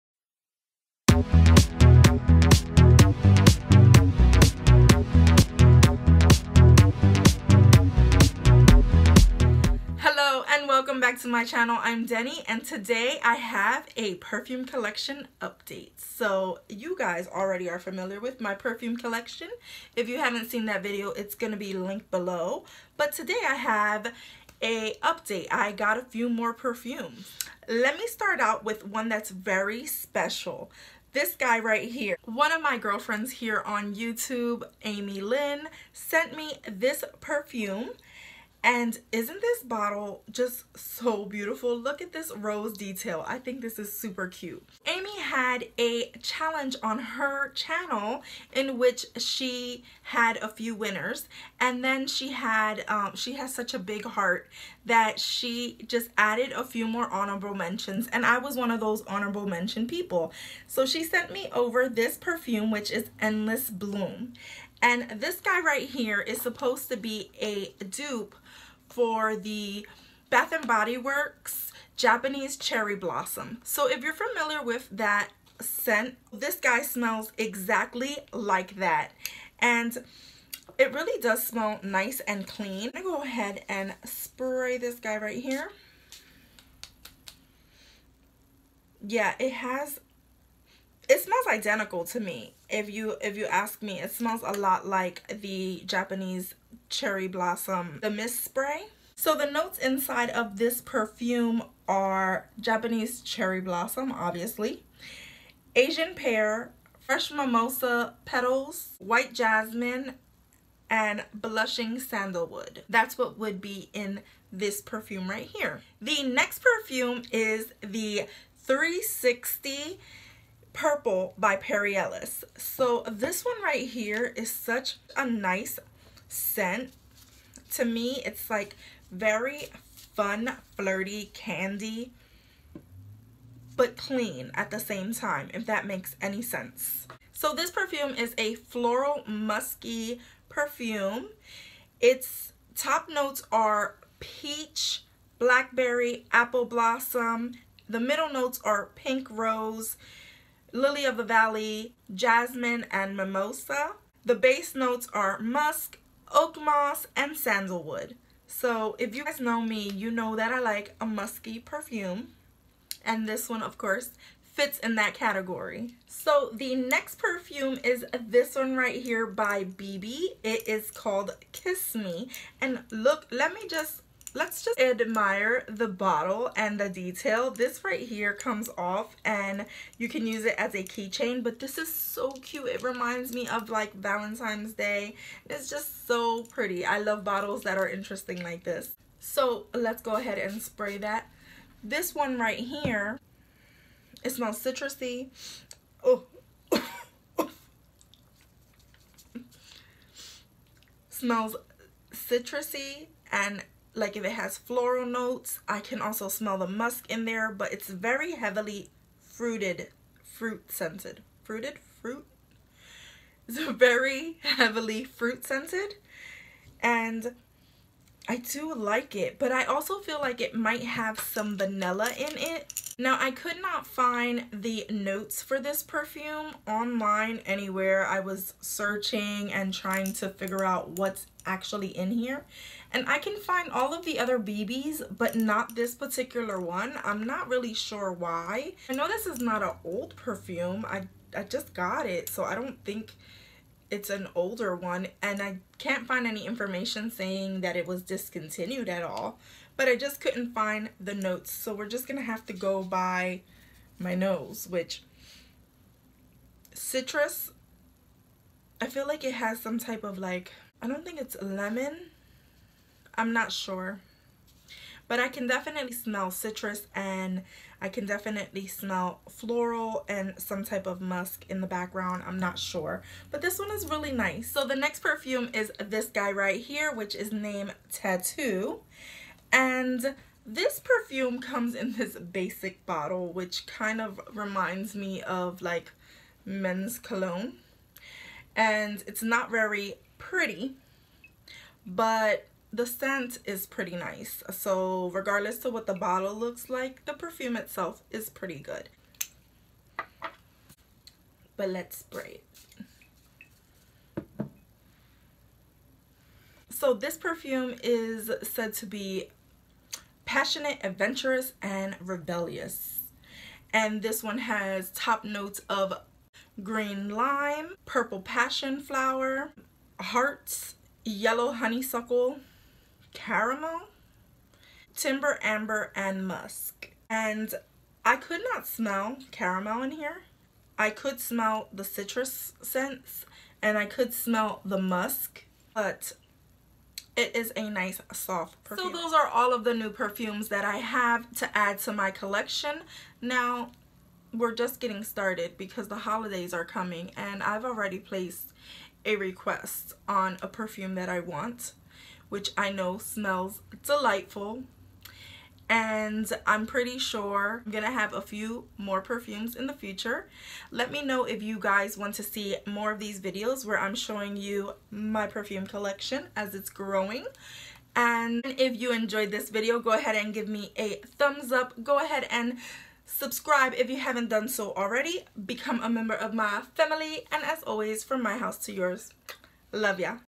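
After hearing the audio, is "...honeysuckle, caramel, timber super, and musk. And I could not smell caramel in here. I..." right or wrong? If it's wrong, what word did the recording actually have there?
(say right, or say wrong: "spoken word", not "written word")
wrong: "amber", not "super".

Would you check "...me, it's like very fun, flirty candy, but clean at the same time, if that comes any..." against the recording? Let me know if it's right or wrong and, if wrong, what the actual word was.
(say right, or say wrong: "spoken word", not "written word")
wrong: "makes", not "comes".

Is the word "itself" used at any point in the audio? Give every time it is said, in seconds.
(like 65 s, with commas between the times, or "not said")
297 s.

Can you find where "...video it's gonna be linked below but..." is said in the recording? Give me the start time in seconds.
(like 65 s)
20 s.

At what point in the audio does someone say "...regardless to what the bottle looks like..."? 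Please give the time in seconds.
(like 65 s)
295 s.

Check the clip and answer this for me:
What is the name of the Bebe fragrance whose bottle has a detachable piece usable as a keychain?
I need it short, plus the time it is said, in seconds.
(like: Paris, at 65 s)
Kiss Me, at 171 s.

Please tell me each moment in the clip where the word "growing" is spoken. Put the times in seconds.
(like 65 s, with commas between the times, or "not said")
366 s.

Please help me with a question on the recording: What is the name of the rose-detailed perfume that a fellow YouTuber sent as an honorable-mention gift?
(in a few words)
Endless Bloom.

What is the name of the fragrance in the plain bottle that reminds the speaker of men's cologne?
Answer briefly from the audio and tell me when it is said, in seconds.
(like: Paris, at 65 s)
Tattoo, at 277 s.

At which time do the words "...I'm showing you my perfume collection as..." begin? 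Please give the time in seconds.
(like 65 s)
363 s.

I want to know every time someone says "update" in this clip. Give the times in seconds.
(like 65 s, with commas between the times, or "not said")
15 s, 25 s.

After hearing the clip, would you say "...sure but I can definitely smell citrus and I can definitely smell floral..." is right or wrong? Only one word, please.
right.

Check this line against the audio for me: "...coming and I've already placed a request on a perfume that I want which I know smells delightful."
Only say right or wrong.
right.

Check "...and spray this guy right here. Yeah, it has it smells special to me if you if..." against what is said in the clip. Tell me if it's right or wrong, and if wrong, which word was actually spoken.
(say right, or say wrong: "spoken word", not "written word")
wrong: "identical", not "special".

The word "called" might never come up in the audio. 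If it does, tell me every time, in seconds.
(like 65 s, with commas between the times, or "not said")
170 s.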